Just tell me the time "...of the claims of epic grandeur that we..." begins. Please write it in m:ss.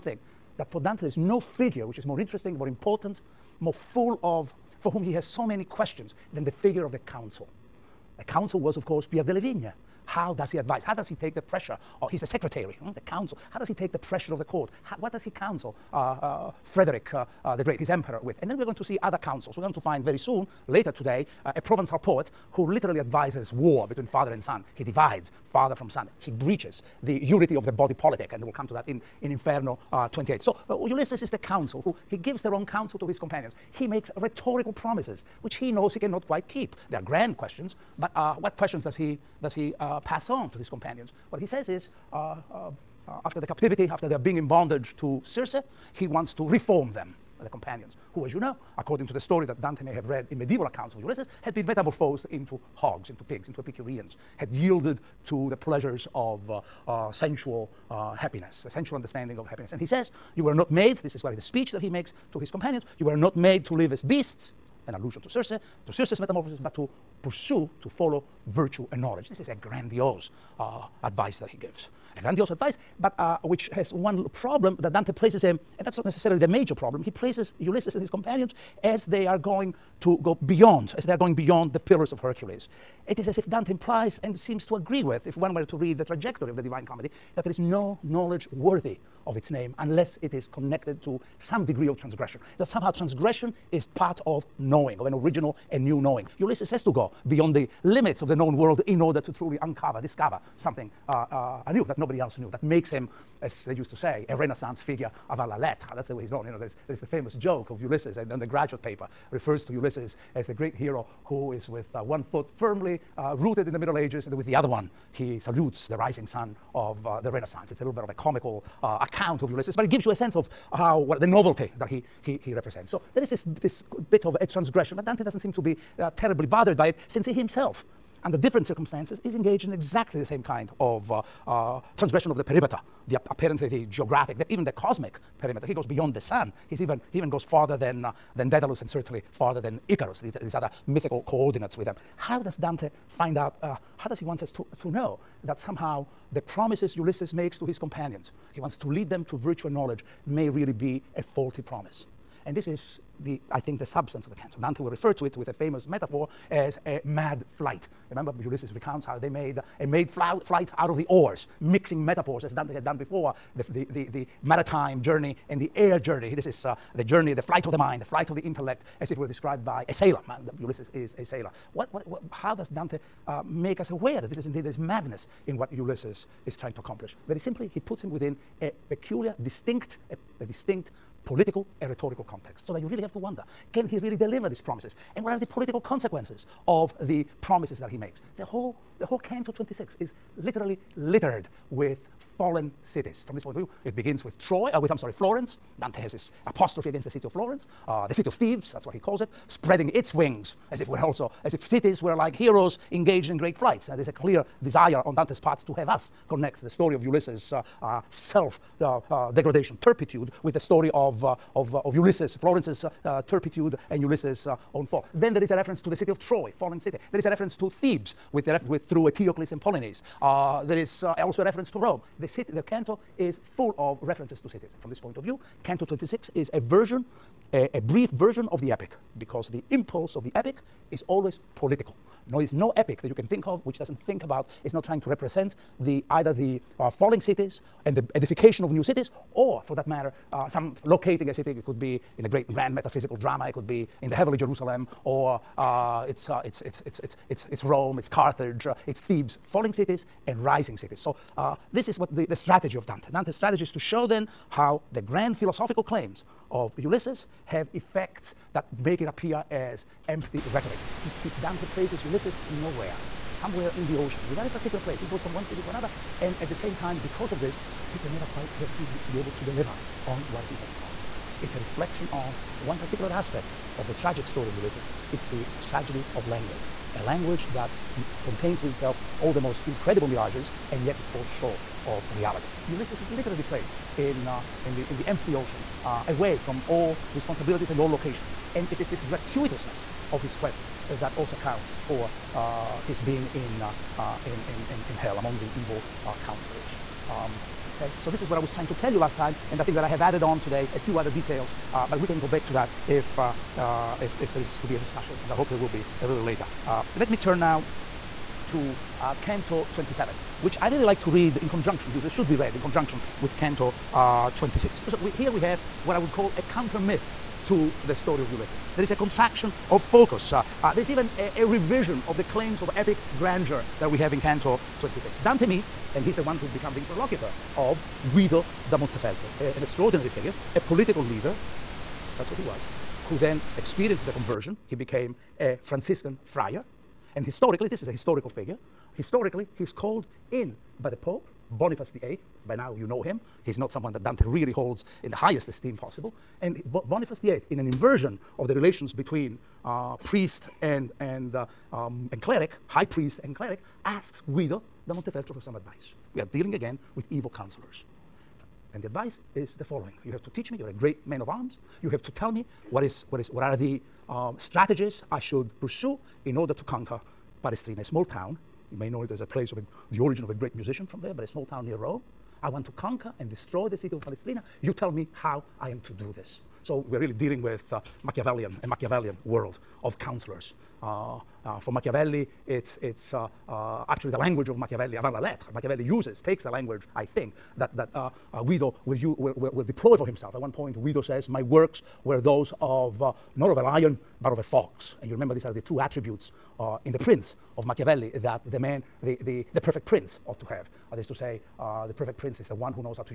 5:22.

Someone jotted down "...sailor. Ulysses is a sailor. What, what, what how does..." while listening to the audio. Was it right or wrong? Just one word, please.
right.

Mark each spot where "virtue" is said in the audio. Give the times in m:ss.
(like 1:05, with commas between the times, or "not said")
1:08, 2:29.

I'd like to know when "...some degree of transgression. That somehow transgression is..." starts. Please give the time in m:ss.
1:31.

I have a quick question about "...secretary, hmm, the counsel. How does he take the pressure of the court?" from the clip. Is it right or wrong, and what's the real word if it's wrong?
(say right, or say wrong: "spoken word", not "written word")
right.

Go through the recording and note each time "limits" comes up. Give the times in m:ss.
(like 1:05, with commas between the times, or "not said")
1:37.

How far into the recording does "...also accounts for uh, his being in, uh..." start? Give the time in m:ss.
4:51.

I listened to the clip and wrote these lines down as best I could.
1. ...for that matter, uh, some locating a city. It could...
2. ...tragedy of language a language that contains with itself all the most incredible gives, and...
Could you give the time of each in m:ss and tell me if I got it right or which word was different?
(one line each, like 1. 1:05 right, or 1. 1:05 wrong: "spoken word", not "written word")
1. 3:59 right
2. 4:35 wrong: "mirages", not "gives".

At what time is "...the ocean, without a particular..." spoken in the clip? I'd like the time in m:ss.
4:23.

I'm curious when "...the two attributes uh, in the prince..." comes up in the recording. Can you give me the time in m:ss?
6:35.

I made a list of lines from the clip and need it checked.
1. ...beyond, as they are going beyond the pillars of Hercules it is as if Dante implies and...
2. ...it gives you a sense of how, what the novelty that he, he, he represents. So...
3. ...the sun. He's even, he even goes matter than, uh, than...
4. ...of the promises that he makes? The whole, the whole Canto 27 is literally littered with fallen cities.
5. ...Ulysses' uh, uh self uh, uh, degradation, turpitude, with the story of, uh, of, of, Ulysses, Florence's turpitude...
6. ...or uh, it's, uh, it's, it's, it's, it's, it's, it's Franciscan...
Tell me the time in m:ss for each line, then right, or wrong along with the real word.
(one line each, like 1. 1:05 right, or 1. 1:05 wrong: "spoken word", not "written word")
1. 1:20 right
2. 1:59 right
3. 2:16 wrong: "farther", not "matter"
4. 3:06 wrong: "26", not "27"
5. 3:27 right
6. 4:05 wrong: "Rome", not "Franciscan".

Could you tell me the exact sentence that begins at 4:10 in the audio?
So uh, this is what the, the strategy of Dante.